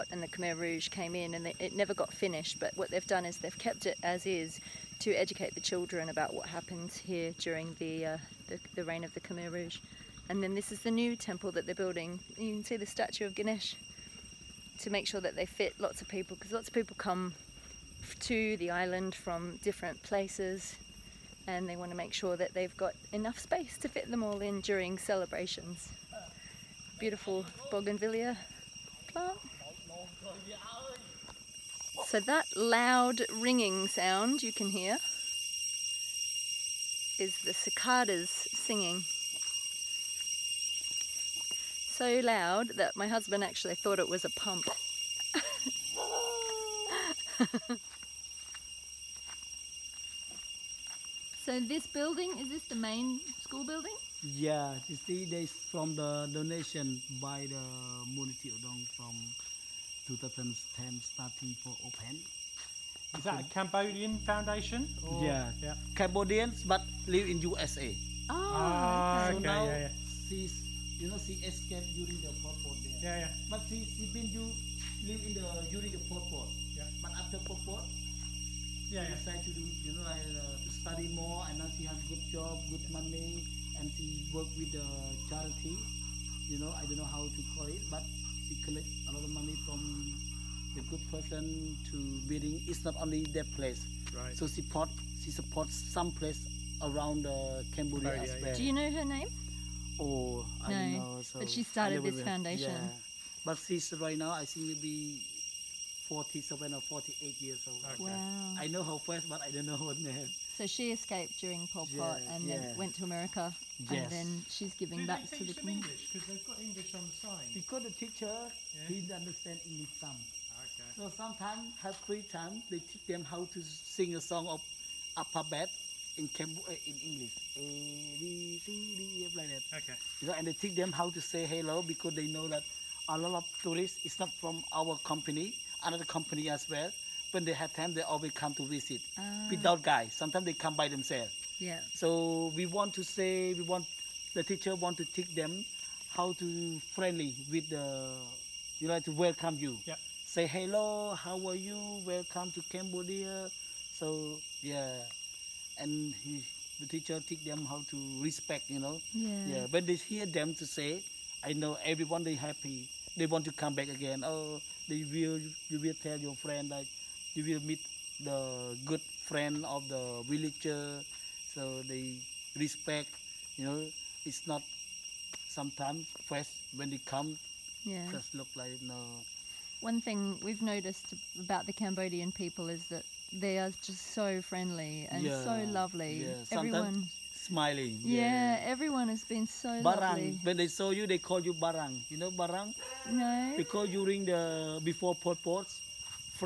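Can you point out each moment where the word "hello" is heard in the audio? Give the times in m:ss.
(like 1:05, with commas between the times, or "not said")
2:11, 2:30.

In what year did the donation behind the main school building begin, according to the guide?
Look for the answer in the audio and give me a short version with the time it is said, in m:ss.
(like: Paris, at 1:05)
2010, at 1:00.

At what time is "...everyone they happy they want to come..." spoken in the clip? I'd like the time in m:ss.
2:41.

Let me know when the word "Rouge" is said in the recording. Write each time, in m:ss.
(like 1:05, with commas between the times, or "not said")
0:00, 0:09.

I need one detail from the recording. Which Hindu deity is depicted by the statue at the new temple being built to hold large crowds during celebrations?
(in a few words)
Ganesh.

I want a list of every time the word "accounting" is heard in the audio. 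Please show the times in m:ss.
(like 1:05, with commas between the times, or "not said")
not said.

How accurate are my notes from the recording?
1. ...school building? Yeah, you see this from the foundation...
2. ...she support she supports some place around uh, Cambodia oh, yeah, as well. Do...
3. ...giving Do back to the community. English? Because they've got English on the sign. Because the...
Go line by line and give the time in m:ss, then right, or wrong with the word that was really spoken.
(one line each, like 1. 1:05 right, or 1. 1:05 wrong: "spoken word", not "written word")
1. 0:53 wrong: "donation", not "foundation"
2. 1:34 right
3. 1:54 right.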